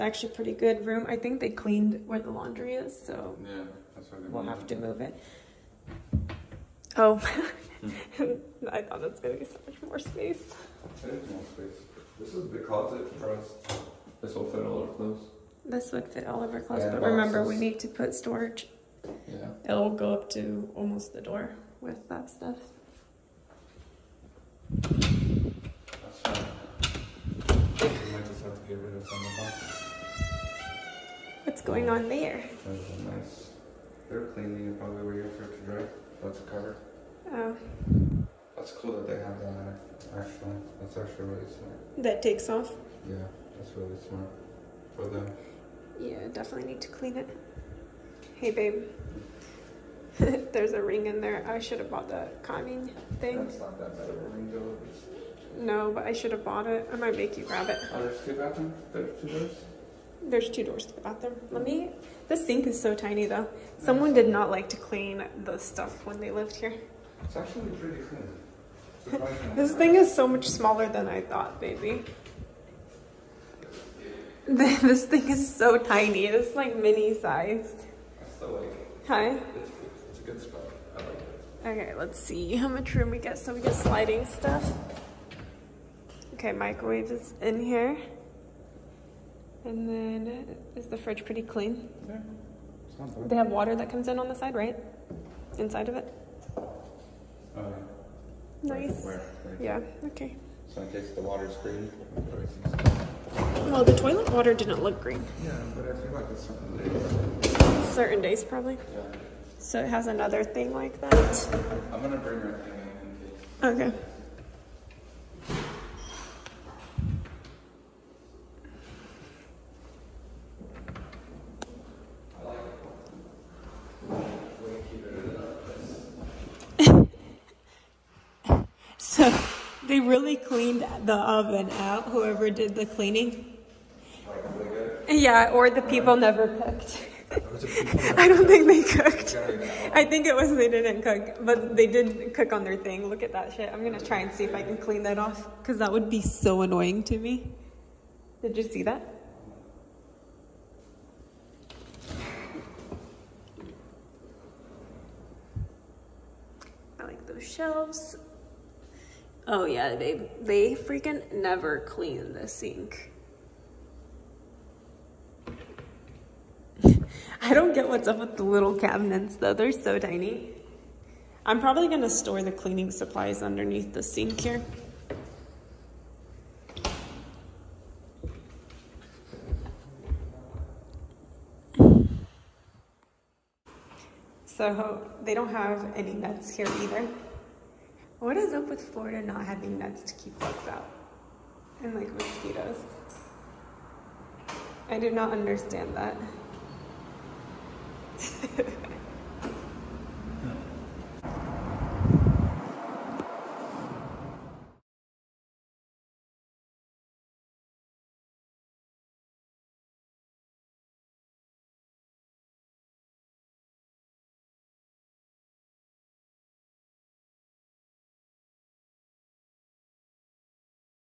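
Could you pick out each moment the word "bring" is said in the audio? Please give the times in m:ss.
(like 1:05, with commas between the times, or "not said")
1:52.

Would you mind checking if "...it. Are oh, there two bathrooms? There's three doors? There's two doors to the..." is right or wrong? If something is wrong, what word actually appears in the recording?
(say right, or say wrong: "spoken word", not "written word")
wrong: "two", not "three".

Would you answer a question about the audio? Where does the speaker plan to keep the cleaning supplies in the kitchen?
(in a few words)
Underneath the sink.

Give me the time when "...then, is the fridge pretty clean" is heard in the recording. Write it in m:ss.
1:29.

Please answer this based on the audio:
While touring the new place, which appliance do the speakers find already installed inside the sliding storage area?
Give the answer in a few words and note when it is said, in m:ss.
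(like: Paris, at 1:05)
Microwave, at 1:26.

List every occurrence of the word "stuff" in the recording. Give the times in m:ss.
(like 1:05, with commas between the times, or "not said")
0:22, 1:05, 1:24.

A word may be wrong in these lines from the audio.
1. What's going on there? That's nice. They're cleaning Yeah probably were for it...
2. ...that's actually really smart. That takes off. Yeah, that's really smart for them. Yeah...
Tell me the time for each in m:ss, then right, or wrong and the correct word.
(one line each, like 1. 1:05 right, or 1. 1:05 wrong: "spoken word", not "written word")
1. 0:31 wrong: "You", not "Yeah"
2. 0:40 right.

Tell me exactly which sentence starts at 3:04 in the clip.
So they don't have any nuts here either.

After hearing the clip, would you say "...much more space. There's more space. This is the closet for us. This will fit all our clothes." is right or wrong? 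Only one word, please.
right.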